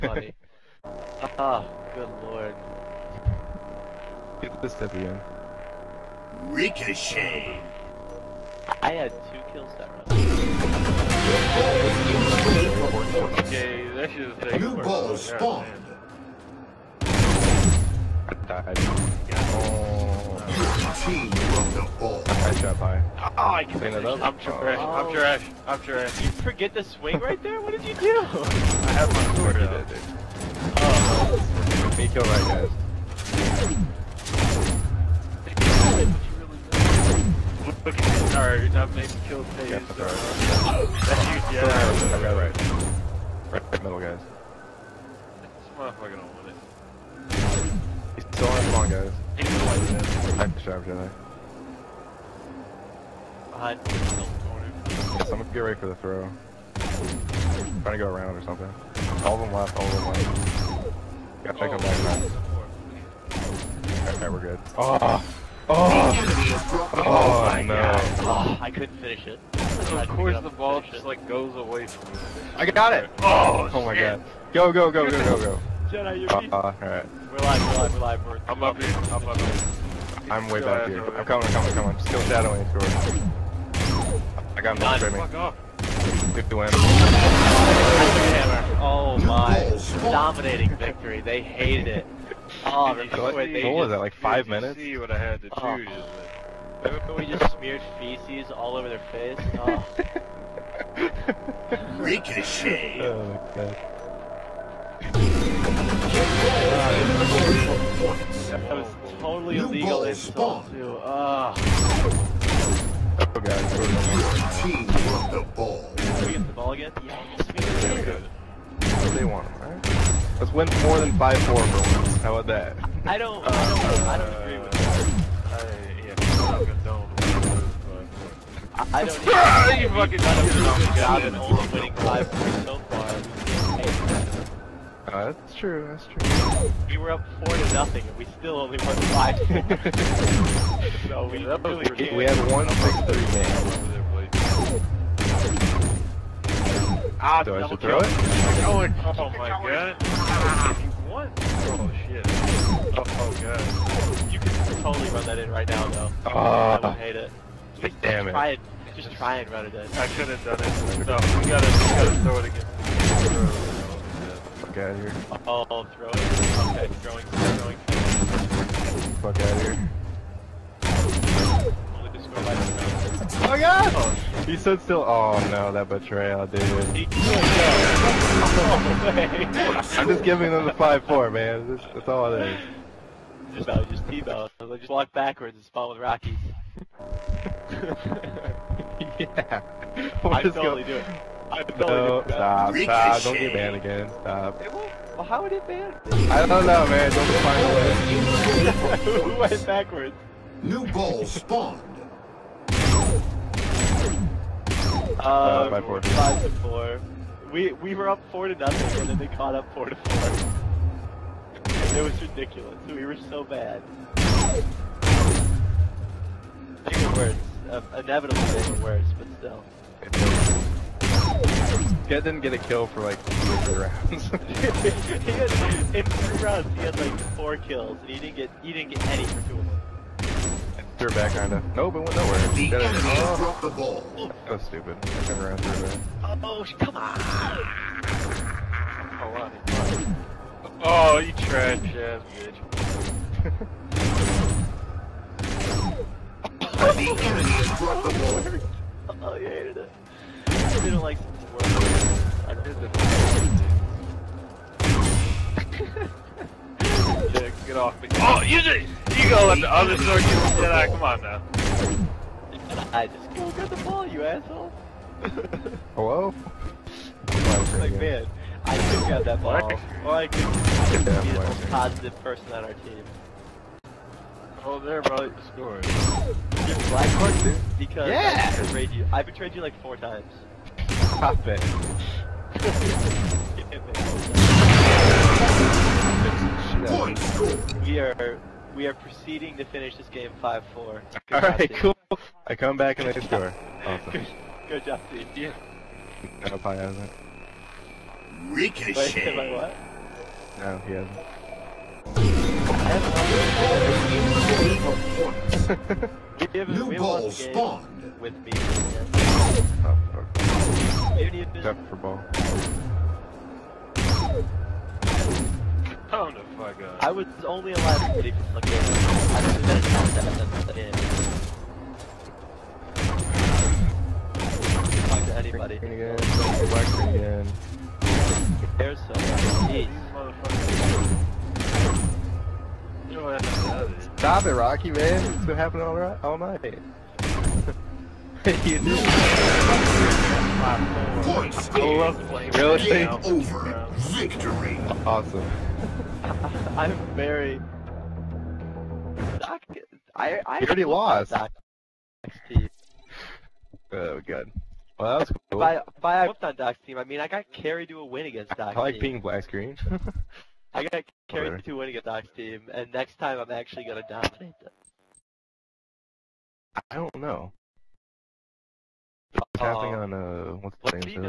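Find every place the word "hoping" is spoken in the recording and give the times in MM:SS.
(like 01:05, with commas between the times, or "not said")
not said.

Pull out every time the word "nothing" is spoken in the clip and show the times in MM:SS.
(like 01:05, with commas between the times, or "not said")
02:17, 03:28.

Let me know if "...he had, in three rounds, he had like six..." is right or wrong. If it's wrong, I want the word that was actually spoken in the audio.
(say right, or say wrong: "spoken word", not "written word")
wrong: "four", not "six".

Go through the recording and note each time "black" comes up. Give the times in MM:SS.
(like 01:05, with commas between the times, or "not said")
04:36, 05:25, 05:59.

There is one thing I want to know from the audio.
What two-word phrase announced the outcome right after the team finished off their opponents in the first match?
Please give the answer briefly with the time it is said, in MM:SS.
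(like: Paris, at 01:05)
Dominating victory, at 01:30.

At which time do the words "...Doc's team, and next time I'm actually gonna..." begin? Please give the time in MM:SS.
06:02.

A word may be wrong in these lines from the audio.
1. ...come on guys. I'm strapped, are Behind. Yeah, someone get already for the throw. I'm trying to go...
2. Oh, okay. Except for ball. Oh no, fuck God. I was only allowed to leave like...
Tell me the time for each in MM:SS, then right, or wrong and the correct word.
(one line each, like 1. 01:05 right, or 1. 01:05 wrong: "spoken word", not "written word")
1. 00:48 wrong: "ready", not "already"
2. 05:08 right.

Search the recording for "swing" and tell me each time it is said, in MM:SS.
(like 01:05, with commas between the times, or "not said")
00:26.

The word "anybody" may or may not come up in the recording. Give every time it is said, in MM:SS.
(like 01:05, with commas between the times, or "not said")
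05:25.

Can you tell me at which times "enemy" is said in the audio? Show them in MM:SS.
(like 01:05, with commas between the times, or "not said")
03:52, 04:07.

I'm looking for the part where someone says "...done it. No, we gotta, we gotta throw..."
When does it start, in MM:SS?
02:40.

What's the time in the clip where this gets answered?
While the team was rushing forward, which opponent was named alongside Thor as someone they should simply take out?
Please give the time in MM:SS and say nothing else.
01:22.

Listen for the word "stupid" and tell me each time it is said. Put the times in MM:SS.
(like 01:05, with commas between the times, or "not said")
03:54.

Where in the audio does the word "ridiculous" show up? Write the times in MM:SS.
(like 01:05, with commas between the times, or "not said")
03:32.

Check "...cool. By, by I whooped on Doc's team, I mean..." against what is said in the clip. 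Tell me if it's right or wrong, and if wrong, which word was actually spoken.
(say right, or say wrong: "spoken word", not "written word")
right.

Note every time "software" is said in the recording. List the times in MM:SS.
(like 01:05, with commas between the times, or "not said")
not said.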